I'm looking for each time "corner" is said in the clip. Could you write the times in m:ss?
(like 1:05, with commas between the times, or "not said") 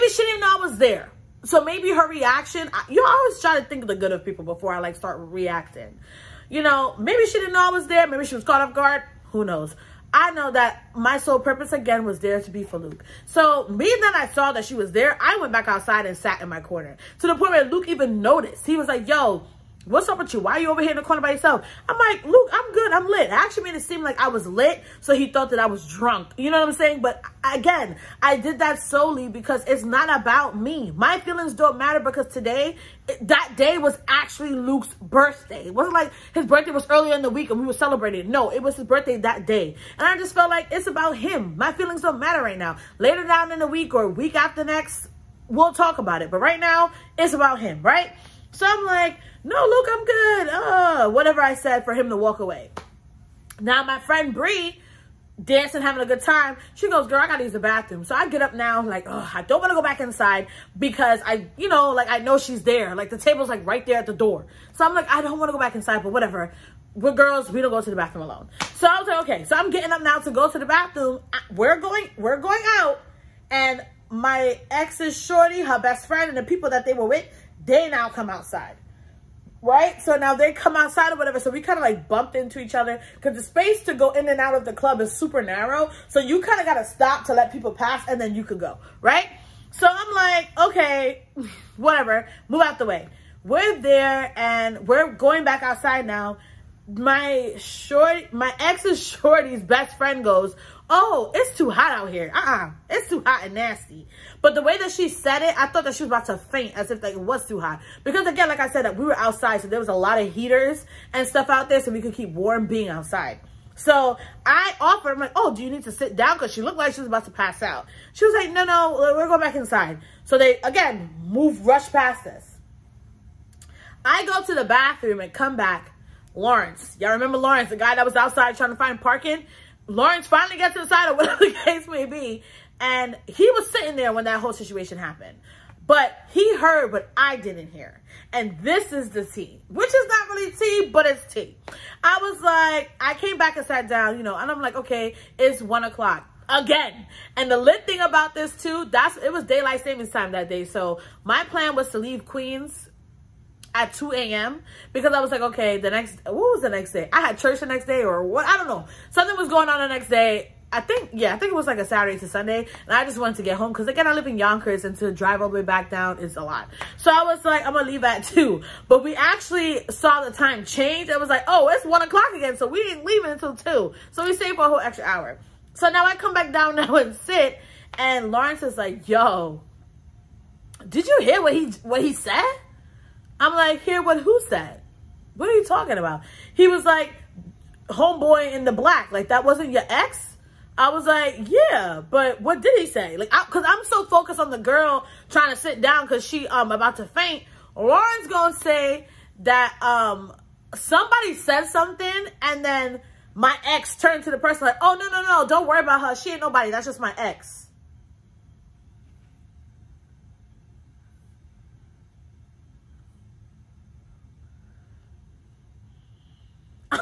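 0:16, 0:21.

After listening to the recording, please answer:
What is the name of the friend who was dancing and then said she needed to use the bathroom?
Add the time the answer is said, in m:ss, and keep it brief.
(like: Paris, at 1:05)
Bree, at 0:54.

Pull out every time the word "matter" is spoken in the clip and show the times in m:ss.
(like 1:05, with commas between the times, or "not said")
0:31, 0:42.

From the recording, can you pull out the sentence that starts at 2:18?
And this is the tea, which is not really tea, but it's tea.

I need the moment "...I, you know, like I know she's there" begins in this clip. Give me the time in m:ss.
1:01.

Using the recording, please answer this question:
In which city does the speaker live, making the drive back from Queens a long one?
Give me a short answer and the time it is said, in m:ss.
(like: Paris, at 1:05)
Yonkers, at 2:44.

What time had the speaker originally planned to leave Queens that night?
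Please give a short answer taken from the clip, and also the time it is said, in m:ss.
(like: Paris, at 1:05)
2 a.m., at 2:33.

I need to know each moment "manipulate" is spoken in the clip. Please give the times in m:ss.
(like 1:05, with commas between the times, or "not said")
not said.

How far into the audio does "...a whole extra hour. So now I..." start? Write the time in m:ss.
2:54.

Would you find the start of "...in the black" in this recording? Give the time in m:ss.
3:08.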